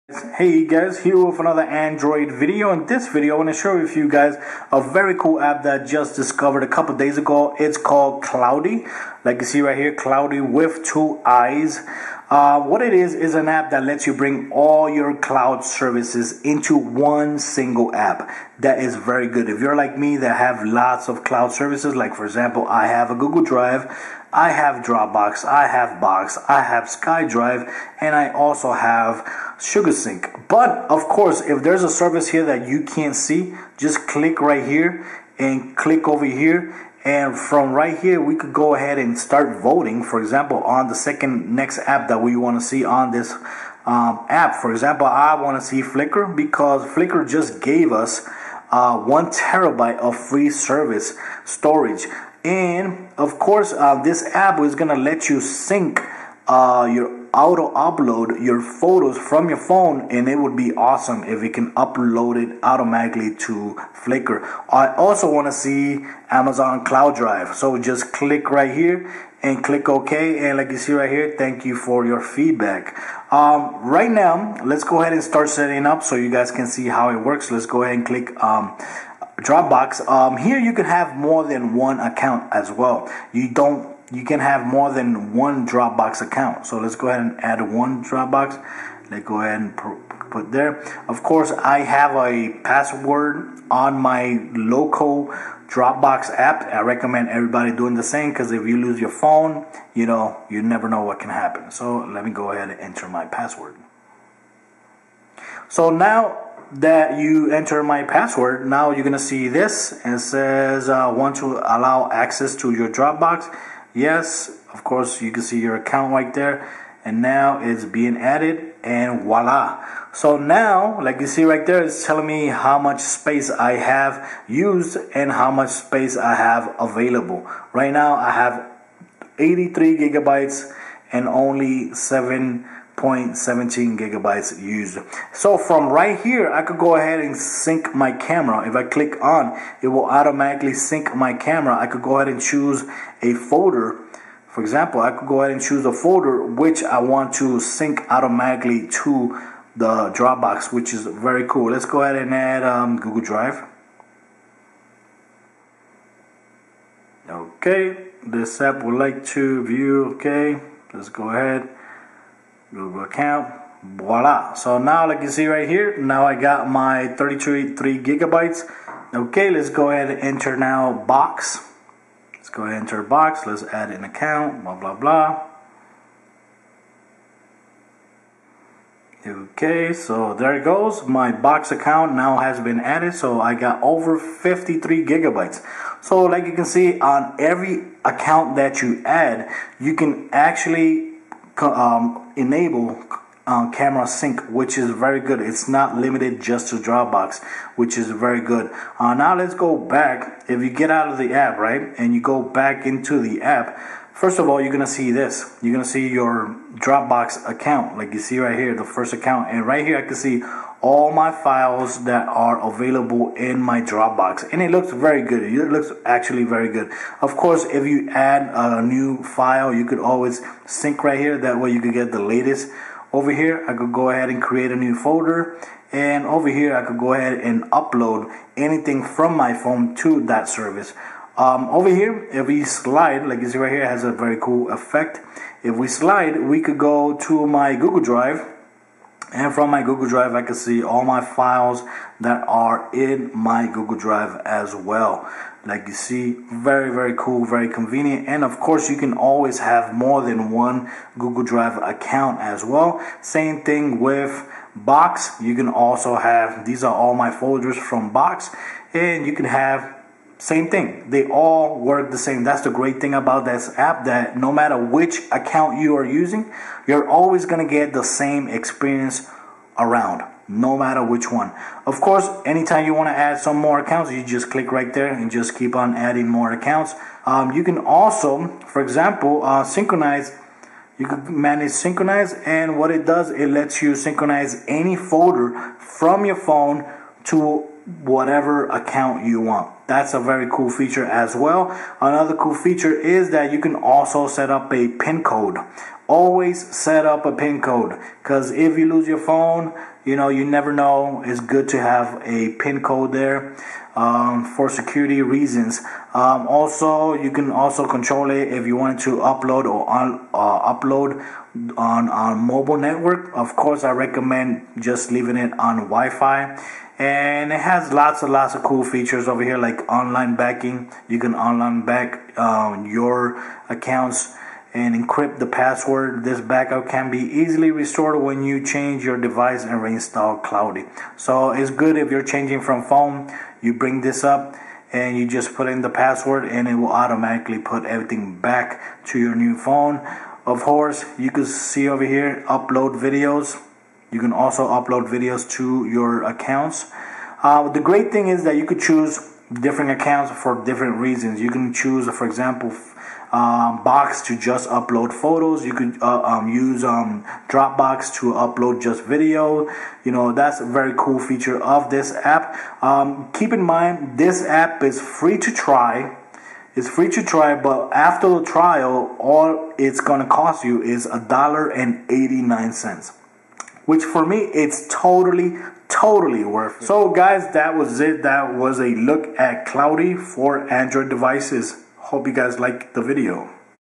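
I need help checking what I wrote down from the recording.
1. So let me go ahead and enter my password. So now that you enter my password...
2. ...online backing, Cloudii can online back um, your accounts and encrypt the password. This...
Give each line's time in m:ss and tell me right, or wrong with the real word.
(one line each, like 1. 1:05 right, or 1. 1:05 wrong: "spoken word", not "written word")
1. 1:41 right
2. 5:19 wrong: "You", not "Cloudii".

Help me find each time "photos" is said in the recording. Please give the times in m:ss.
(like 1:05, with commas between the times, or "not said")
0:58, 5:55.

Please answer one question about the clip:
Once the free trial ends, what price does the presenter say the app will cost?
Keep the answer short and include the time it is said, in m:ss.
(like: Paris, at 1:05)
$1.89, at 6:11.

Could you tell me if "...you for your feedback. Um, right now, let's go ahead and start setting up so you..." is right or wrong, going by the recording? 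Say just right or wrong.
right.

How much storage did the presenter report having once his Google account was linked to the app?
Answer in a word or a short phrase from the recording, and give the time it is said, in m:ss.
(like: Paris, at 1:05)
32 gigabytes, at 2:47.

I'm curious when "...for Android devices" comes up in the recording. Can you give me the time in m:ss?
6:20.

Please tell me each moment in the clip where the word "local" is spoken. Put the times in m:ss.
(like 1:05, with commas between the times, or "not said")
1:34.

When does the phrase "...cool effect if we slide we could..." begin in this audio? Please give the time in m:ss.
3:54.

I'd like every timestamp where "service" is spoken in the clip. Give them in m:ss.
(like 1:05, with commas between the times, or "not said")
0:15, 0:21, 0:31, 0:50, 3:50.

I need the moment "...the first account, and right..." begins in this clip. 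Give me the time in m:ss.
3:28.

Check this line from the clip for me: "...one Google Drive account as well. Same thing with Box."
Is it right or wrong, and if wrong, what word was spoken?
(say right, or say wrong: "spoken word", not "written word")
right.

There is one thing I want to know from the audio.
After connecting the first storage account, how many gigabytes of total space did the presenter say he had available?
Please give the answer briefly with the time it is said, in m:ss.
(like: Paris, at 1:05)
83 gigabytes, at 2:09.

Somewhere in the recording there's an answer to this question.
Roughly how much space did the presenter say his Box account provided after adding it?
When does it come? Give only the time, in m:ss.
3:04.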